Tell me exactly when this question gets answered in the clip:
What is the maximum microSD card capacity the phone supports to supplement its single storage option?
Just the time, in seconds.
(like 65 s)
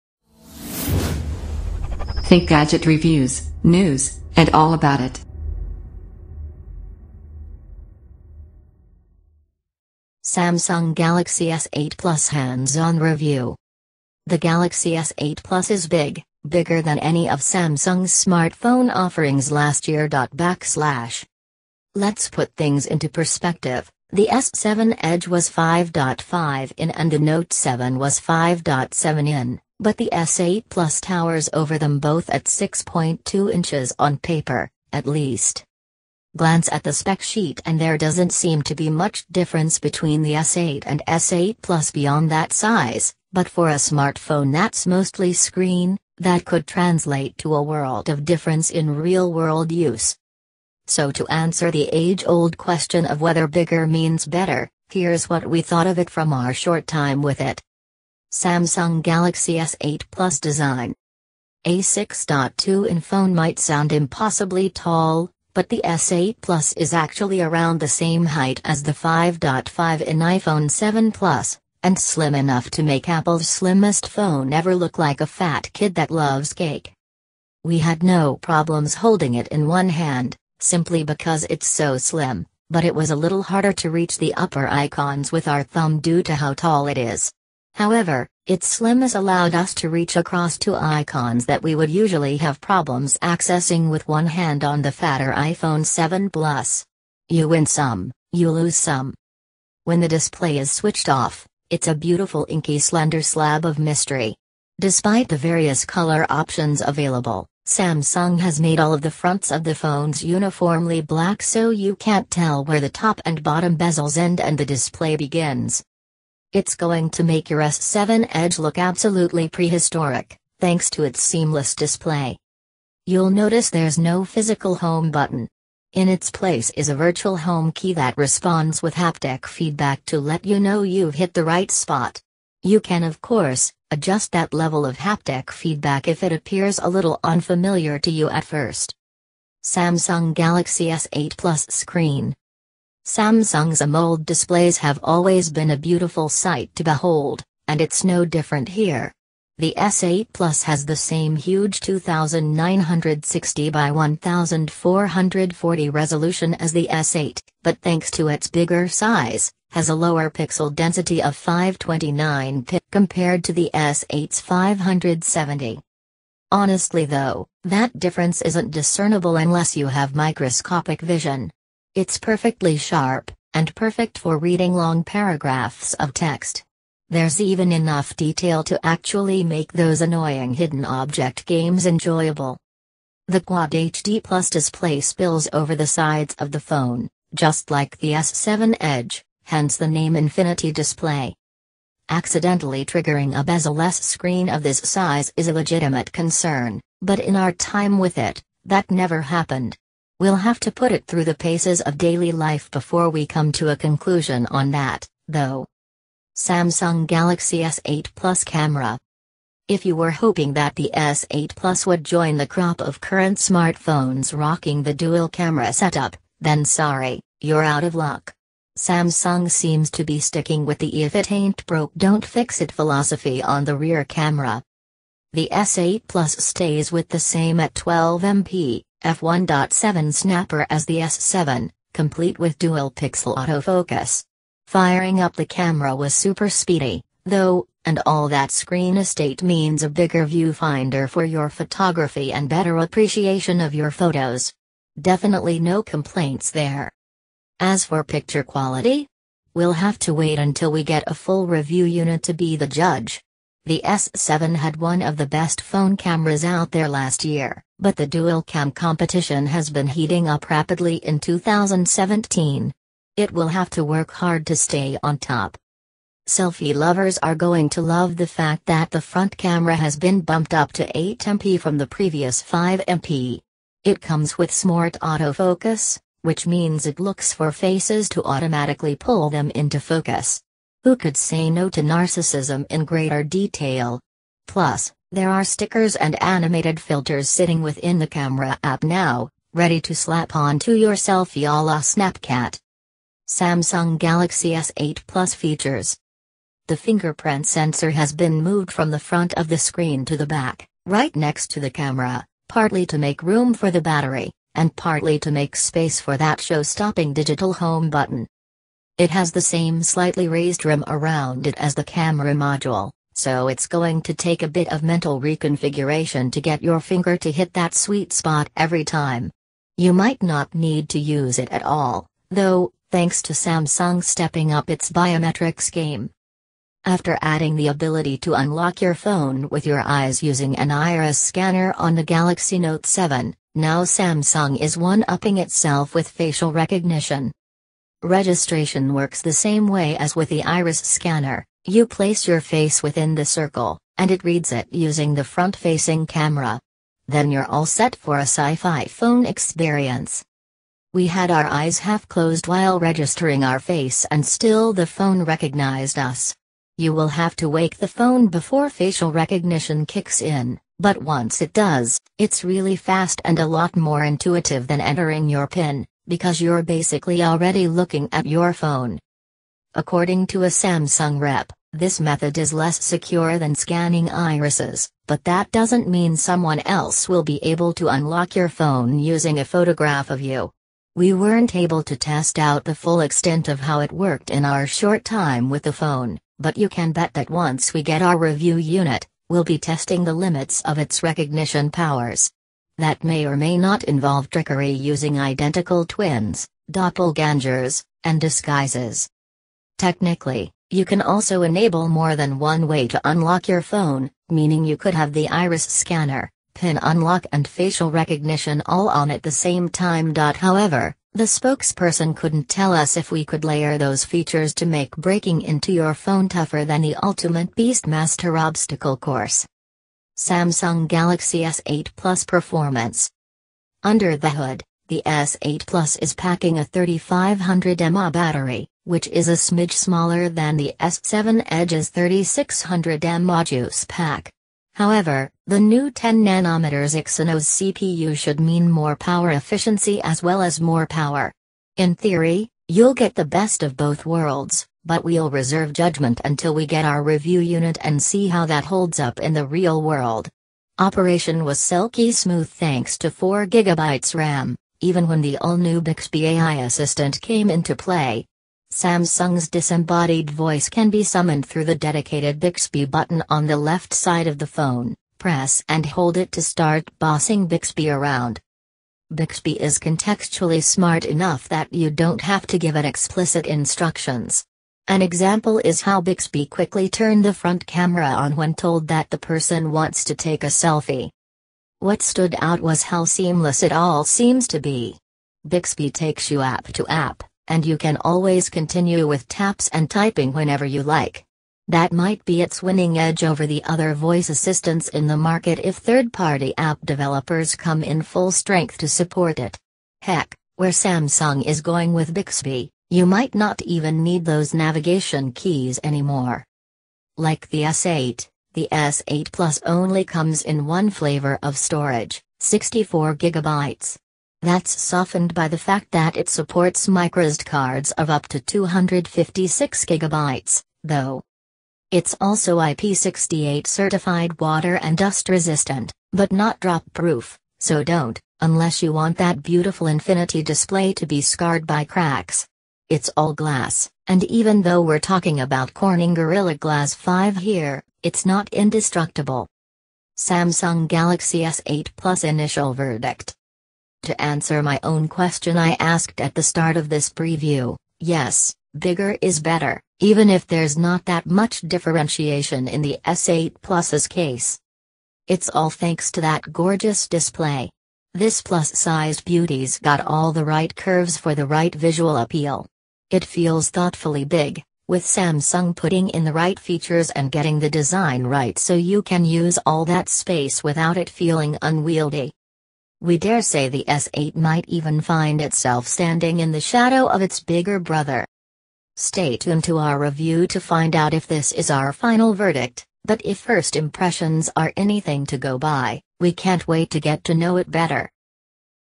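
518 s.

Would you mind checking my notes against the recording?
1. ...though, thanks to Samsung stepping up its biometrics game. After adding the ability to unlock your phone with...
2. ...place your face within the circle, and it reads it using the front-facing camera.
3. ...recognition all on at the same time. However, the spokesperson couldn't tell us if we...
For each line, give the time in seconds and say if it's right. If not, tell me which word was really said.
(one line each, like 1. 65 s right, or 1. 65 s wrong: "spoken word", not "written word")
1. 322 s right
2. 341 s right
3. 407 s right.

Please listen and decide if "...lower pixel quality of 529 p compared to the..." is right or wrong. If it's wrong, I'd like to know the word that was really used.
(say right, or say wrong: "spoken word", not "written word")
wrong: "density", not "quality".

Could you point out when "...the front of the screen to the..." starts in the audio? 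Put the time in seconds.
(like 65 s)
298 s.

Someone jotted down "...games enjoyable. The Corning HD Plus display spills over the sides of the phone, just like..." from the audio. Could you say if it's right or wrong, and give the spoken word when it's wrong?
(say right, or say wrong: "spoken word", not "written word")
wrong: "Quad", not "Corning".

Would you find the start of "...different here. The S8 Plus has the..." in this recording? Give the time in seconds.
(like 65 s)
148 s.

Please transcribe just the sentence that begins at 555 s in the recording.
It's all thanks to that gorgeous display.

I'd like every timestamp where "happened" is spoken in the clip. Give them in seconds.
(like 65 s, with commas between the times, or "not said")
199 s.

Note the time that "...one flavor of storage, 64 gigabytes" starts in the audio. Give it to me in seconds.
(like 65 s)
510 s.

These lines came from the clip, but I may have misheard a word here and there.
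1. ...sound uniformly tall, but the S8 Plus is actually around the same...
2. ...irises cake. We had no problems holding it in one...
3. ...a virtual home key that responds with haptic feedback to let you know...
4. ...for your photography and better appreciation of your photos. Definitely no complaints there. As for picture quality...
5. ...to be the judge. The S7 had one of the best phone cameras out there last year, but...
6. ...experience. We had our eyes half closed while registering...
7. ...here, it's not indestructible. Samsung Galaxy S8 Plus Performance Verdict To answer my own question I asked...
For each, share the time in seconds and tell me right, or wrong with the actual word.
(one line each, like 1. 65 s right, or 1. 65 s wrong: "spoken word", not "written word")
1. 63 s wrong: "impossibly", not "uniformly"
2. 76 s wrong: "loves", not "irises"
3. 126 s right
4. 241 s right
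5. 252 s right
6. 349 s right
7. 537 s wrong: "Initial", not "Performance".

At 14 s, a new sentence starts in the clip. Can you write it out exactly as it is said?
The Galaxy S8 Plus is big, bigger than any of Samsung's smartphone offerings last year.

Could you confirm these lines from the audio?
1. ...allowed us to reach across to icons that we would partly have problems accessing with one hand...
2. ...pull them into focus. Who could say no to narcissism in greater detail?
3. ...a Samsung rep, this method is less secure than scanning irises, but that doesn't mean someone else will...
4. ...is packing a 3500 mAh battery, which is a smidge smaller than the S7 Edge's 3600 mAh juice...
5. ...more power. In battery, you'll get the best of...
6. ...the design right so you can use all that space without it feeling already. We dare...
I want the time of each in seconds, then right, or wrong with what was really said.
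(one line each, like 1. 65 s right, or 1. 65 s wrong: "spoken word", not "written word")
1. 89 s wrong: "usually", not "partly"
2. 278 s right
3. 370 s right
4. 425 s right
5. 440 s wrong: "theory", not "battery"
6. 567 s wrong: "unwieldy", not "already".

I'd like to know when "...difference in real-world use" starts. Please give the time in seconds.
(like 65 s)
48 s.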